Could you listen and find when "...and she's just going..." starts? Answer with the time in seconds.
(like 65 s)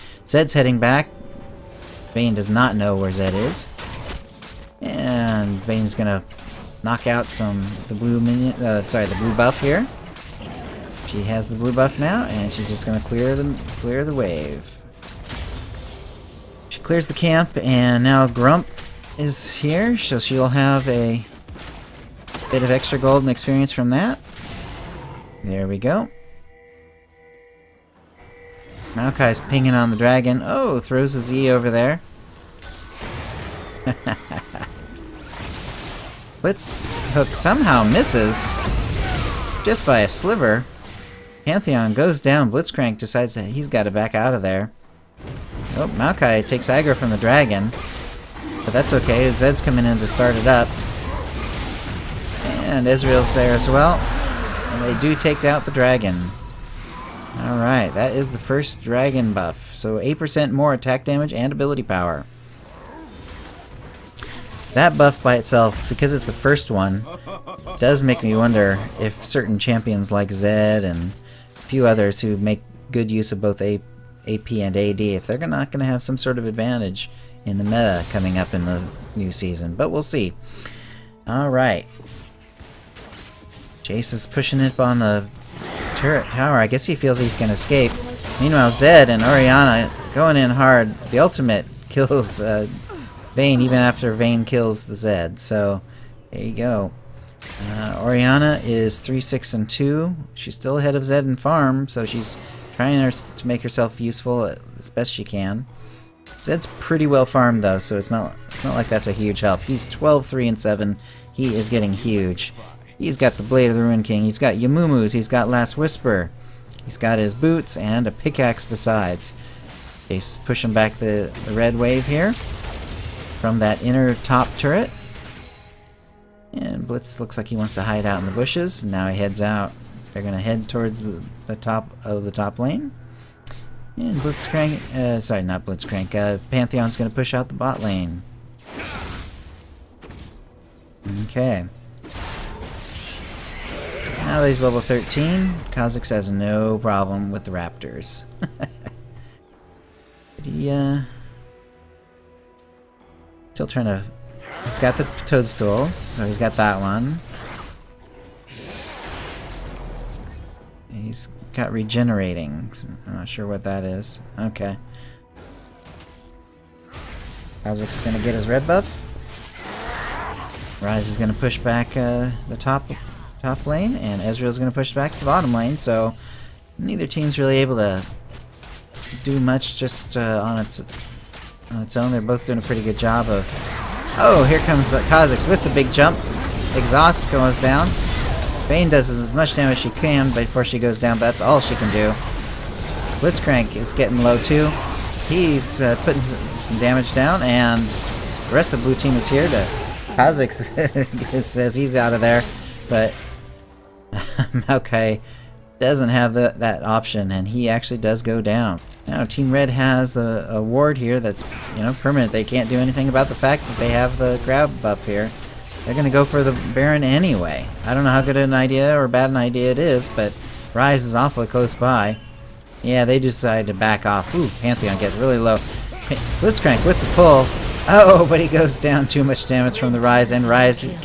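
12 s.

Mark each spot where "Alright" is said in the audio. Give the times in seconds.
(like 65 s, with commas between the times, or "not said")
57 s, 81 s.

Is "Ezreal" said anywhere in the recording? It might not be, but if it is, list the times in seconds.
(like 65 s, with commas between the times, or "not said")
52 s, 174 s.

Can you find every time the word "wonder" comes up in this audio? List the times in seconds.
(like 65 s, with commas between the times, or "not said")
68 s.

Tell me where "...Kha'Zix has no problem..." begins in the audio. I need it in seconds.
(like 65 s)
145 s.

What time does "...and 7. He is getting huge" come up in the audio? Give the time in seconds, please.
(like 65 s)
110 s.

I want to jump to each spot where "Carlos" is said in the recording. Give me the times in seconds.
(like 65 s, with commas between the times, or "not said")
not said.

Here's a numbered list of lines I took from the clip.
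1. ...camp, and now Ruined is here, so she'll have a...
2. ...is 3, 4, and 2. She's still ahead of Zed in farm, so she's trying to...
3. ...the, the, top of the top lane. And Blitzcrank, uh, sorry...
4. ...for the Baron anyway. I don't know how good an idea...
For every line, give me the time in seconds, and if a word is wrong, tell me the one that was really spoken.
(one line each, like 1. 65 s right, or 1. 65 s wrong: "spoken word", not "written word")
1. 17 s wrong: "Grump", not "Ruined"
2. 98 s wrong: "6", not "4"
3. 131 s right
4. 216 s right.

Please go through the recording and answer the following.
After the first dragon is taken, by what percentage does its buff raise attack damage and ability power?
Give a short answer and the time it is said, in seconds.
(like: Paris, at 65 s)
8%, at 59 s.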